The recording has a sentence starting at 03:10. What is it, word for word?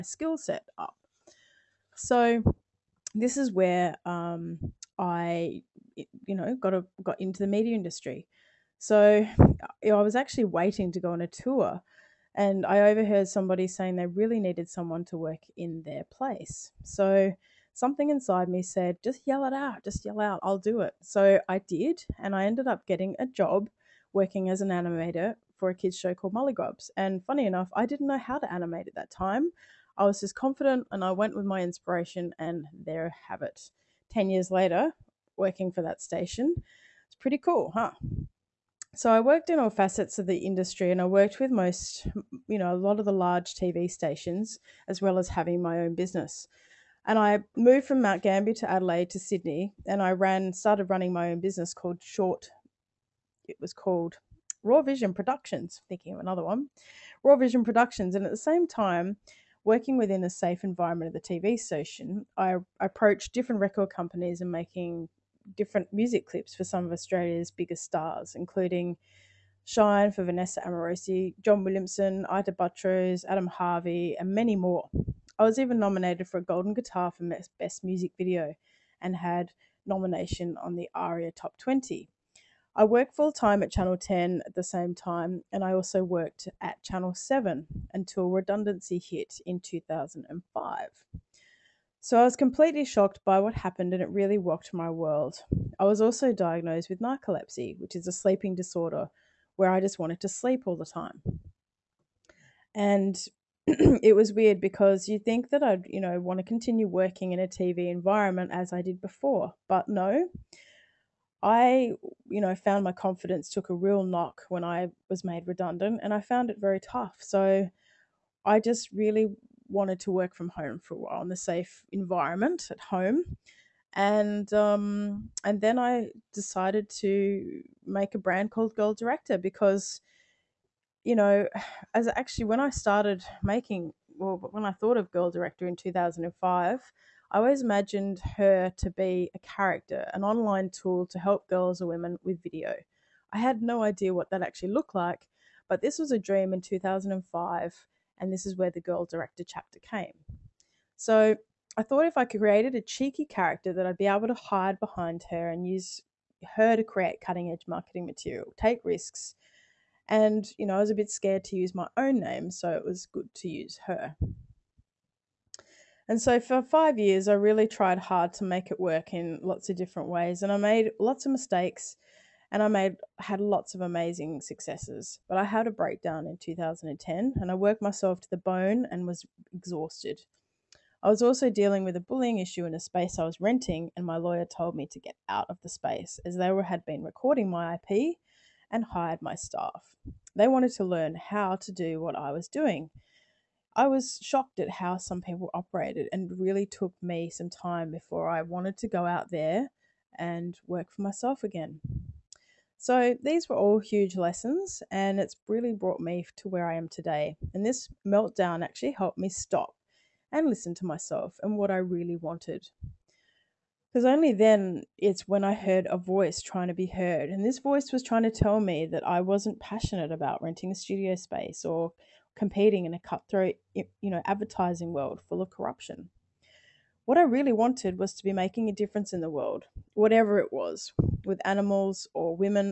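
They wanted to learn how to do what I was doing.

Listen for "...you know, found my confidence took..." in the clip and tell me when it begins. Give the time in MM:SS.
01:52.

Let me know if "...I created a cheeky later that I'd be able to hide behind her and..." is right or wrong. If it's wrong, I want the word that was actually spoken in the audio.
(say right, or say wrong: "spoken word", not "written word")
wrong: "character", not "later".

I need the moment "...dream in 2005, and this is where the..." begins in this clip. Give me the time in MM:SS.
02:26.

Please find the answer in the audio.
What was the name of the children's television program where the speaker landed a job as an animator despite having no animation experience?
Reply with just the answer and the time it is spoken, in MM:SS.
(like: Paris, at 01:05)
Mulligrubs, at 00:26.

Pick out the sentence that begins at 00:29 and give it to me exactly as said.
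I was just confident and I went with my inspiration, and there have it.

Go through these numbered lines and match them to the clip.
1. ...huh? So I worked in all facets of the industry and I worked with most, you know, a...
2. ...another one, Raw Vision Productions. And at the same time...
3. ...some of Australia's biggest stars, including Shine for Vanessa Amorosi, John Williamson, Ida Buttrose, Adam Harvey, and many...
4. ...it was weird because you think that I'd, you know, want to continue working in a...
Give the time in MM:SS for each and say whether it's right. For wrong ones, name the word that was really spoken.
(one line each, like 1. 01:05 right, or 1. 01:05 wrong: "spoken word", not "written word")
1. 00:37 right
2. 00:56 right
3. 01:06 right
4. 01:43 right.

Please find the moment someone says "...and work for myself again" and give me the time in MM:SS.
03:20.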